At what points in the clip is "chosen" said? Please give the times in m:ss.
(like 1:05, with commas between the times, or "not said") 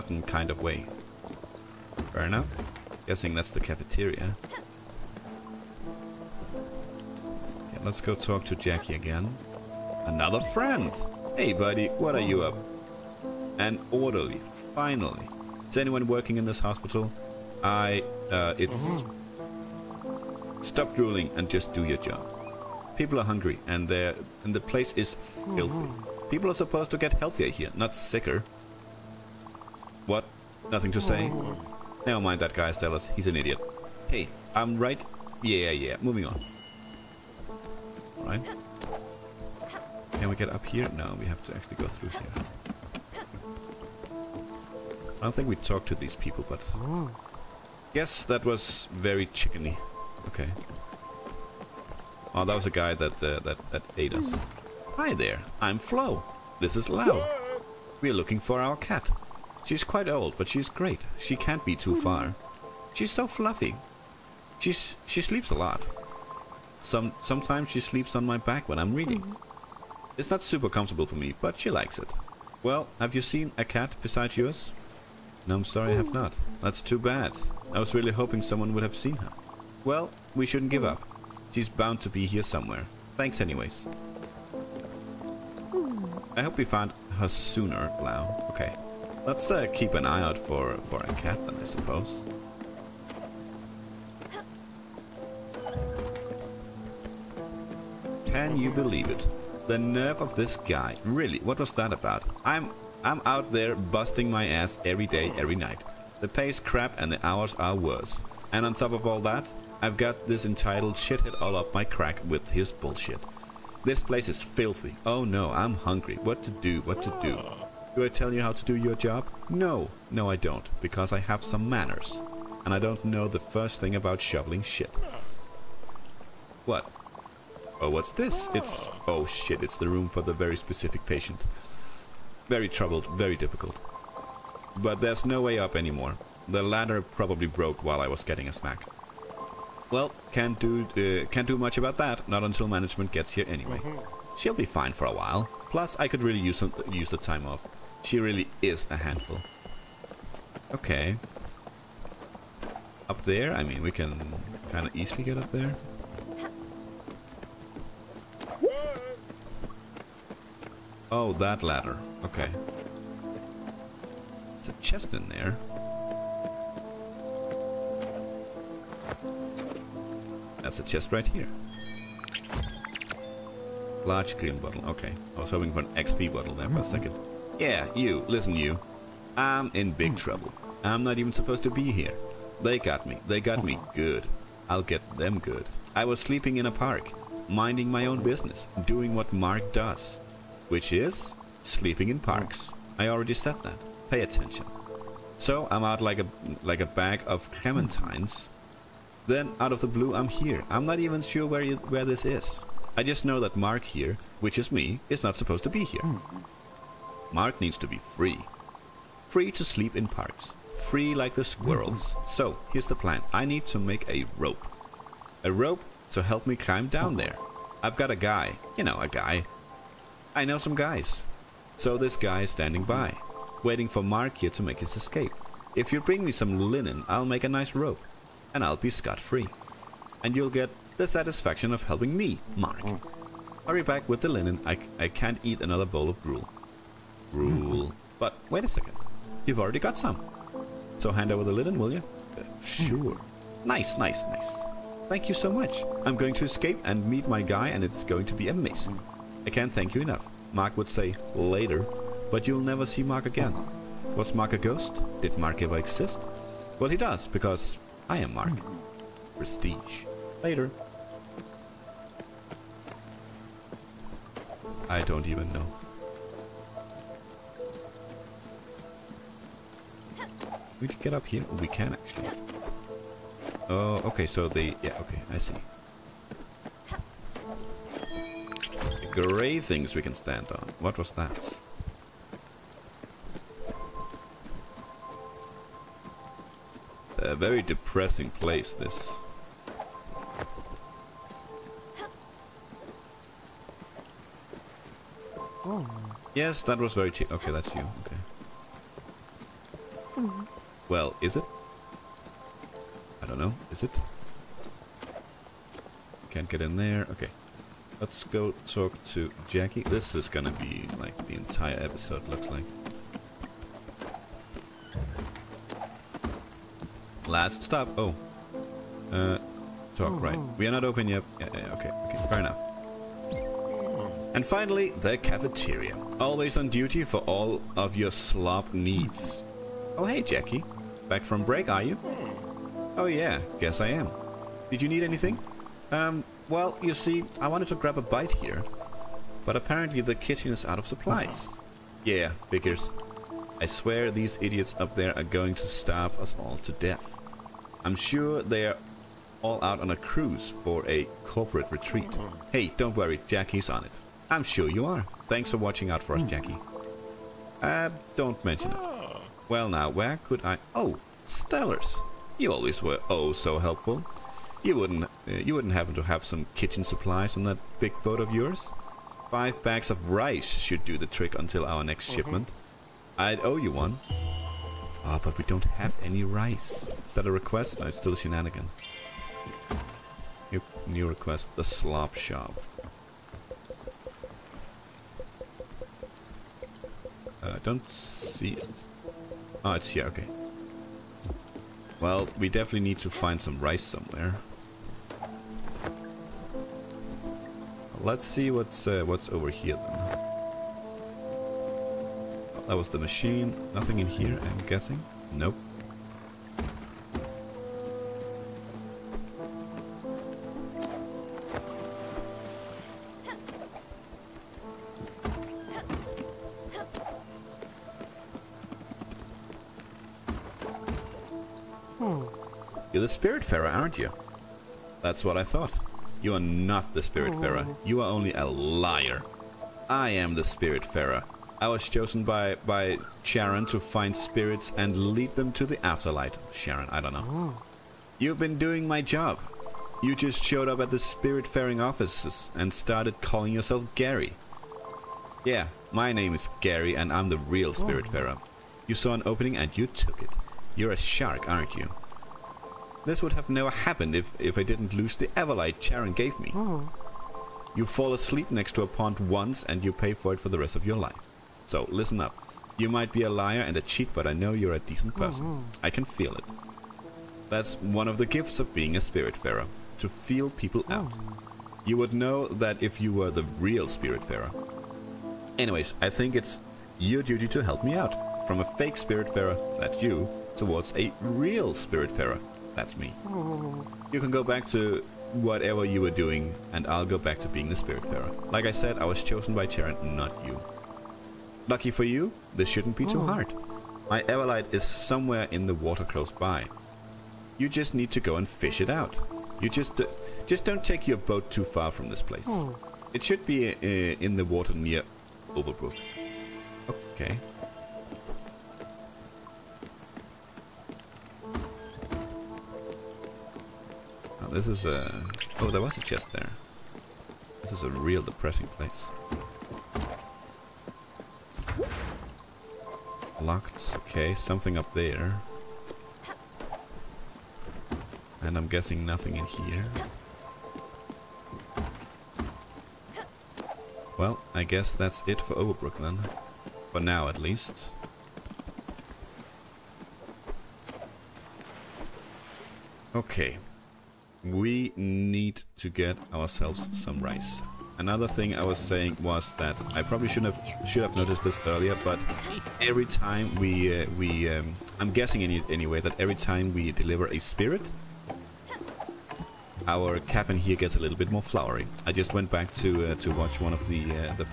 7:11, 8:09.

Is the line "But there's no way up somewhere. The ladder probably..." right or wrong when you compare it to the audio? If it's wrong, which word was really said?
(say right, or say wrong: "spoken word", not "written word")
wrong: "anymore", not "somewhere".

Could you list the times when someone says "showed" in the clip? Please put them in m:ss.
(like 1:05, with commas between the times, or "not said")
7:20.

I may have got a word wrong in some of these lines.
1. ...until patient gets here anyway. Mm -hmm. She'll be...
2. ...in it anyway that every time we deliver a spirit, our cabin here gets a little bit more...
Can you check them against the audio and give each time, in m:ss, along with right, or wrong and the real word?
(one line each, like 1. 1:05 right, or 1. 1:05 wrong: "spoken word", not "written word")
1. 2:22 wrong: "management", not "patient"
2. 9:15 right.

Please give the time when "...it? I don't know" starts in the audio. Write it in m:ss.
5:01.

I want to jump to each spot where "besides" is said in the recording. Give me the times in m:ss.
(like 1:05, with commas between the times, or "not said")
1:14.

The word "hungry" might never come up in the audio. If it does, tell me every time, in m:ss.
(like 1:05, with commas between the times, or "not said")
0:23, 1:55.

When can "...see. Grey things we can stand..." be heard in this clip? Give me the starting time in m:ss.
4:35.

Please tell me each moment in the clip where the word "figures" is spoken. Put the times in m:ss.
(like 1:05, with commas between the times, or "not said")
5:42.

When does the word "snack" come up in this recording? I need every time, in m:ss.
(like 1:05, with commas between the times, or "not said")
2:18.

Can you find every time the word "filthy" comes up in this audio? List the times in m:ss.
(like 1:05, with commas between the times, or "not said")
0:25, 1:54.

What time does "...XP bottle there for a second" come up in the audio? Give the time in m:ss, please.
2:55.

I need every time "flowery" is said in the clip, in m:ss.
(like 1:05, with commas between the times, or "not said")
9:21.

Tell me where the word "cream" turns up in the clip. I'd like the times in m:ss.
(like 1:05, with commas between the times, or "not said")
2:54.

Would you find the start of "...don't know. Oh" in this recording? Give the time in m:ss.
7:17.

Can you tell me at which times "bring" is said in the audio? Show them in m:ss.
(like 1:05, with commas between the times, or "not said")
3:46.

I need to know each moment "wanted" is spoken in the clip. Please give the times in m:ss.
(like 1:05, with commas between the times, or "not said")
5:37.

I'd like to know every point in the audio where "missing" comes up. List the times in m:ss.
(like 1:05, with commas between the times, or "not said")
not said.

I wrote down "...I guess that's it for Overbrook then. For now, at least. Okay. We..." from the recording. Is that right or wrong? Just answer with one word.
right.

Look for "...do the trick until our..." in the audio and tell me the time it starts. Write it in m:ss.
6:10.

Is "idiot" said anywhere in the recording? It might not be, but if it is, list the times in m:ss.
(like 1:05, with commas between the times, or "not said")
0:33, 5:44.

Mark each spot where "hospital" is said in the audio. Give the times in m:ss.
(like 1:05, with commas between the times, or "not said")
0:16.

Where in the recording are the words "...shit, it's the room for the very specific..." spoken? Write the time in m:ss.
2:09.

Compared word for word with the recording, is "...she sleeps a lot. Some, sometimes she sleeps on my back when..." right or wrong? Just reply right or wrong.
right.